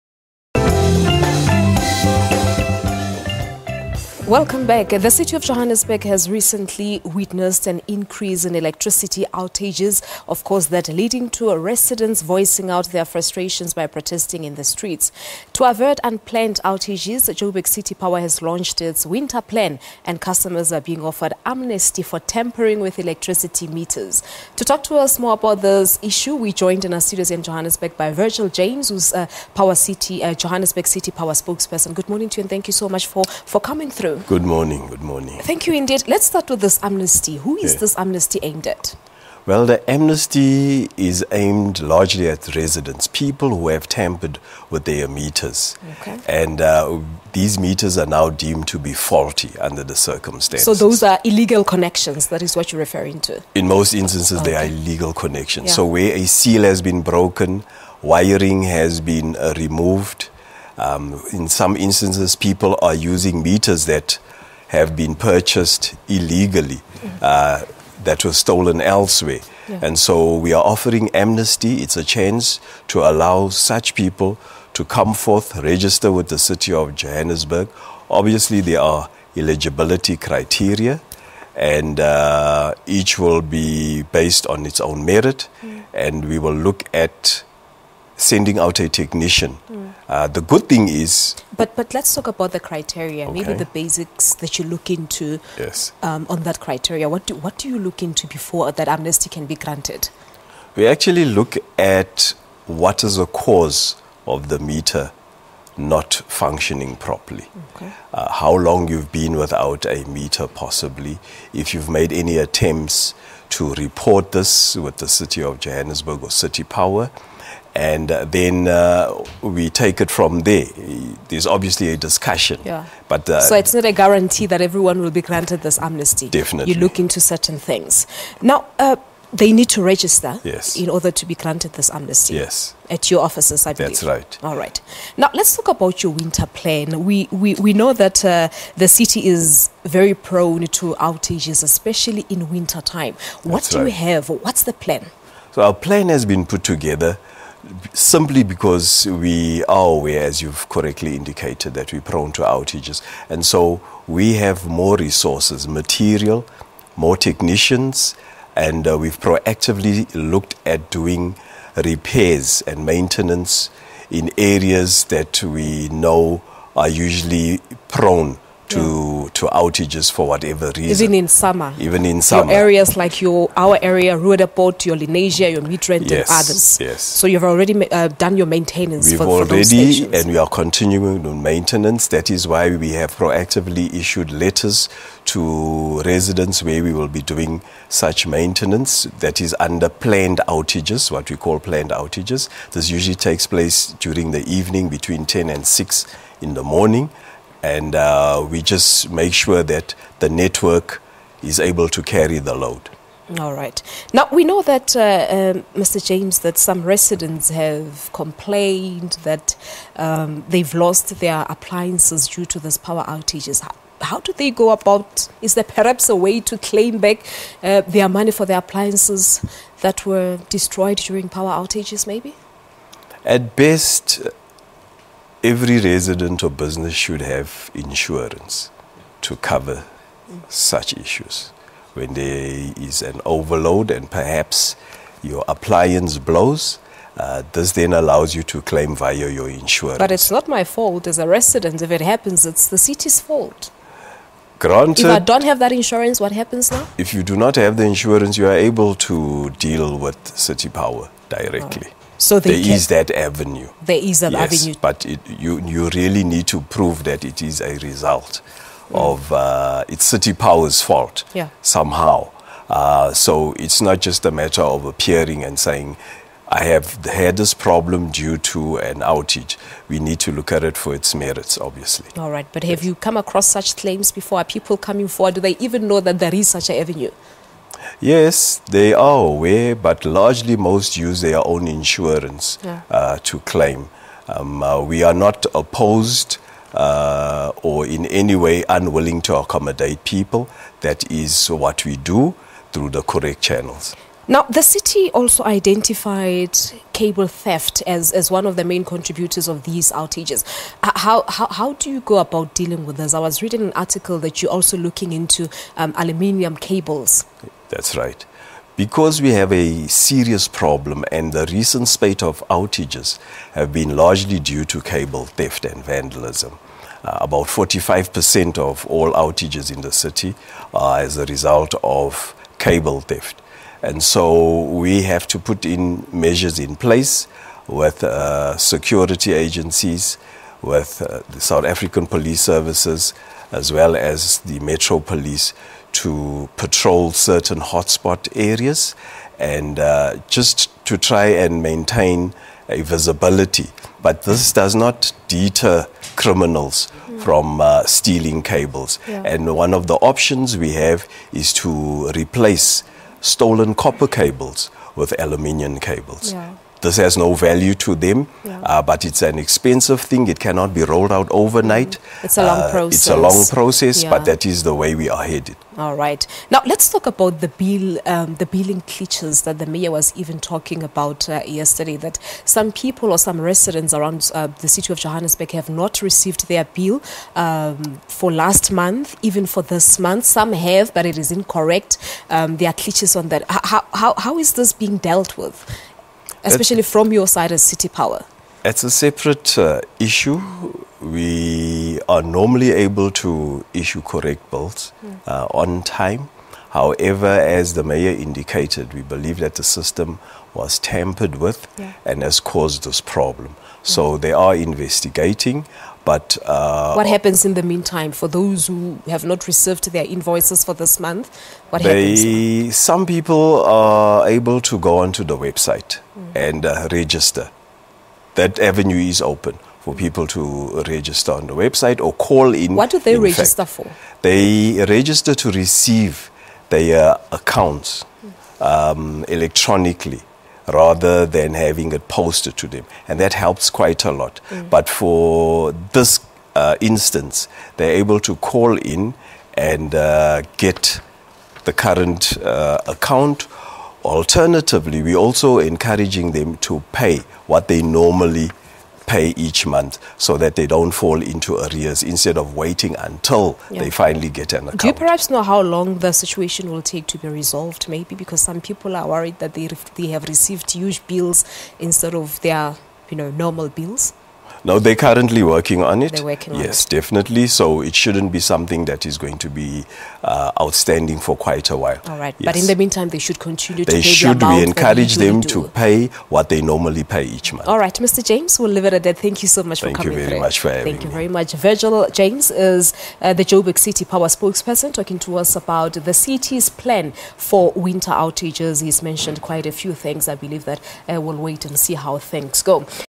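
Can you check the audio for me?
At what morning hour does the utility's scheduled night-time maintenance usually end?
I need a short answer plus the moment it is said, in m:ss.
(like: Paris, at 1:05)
6, at 3:15.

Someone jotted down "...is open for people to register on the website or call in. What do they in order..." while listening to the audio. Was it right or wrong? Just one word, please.
wrong.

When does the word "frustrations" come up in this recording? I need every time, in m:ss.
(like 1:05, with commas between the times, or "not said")
0:13.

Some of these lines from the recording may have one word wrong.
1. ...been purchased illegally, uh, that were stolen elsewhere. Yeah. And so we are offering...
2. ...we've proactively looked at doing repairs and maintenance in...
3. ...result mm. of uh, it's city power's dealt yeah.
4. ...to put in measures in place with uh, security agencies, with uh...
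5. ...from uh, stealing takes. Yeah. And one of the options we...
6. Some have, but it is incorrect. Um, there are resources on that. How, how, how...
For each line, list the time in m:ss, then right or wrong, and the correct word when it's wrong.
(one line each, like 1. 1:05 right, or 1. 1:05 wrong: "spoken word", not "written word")
1. 1:04 right
2. 2:38 right
3. 4:17 wrong: "fault", not "dealt"
4. 5:25 right
5. 5:47 wrong: "cables", not "takes"
6. 6:20 wrong: "glitches", not "resources".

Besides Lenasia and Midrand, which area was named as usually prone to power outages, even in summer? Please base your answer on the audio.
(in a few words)
Roodepoort.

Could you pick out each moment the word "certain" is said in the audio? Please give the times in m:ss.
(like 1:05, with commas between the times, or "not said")
2:07, 5:37.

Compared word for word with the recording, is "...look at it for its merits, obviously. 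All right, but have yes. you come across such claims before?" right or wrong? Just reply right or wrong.
right.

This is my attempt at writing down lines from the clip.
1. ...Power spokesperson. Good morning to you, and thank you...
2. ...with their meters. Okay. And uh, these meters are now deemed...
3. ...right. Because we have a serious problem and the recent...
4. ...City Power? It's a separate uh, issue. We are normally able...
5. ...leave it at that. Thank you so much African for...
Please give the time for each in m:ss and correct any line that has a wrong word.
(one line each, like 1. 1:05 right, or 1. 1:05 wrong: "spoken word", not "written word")
1. 0:31 right
2. 0:44 right
3. 5:07 right
4. 6:27 right
5. 7:58 wrong: "Thank", not "African".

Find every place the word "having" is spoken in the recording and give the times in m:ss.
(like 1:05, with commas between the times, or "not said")
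7:11, 8:00.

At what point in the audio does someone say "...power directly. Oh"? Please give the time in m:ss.
4:10.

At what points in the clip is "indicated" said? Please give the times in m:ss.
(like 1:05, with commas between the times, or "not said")
2:31, 6:38.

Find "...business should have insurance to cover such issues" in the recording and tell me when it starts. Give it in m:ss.
3:46.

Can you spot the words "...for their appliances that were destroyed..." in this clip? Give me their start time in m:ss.
3:38.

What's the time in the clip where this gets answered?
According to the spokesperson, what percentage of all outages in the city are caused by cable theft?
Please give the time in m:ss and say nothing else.
5:17.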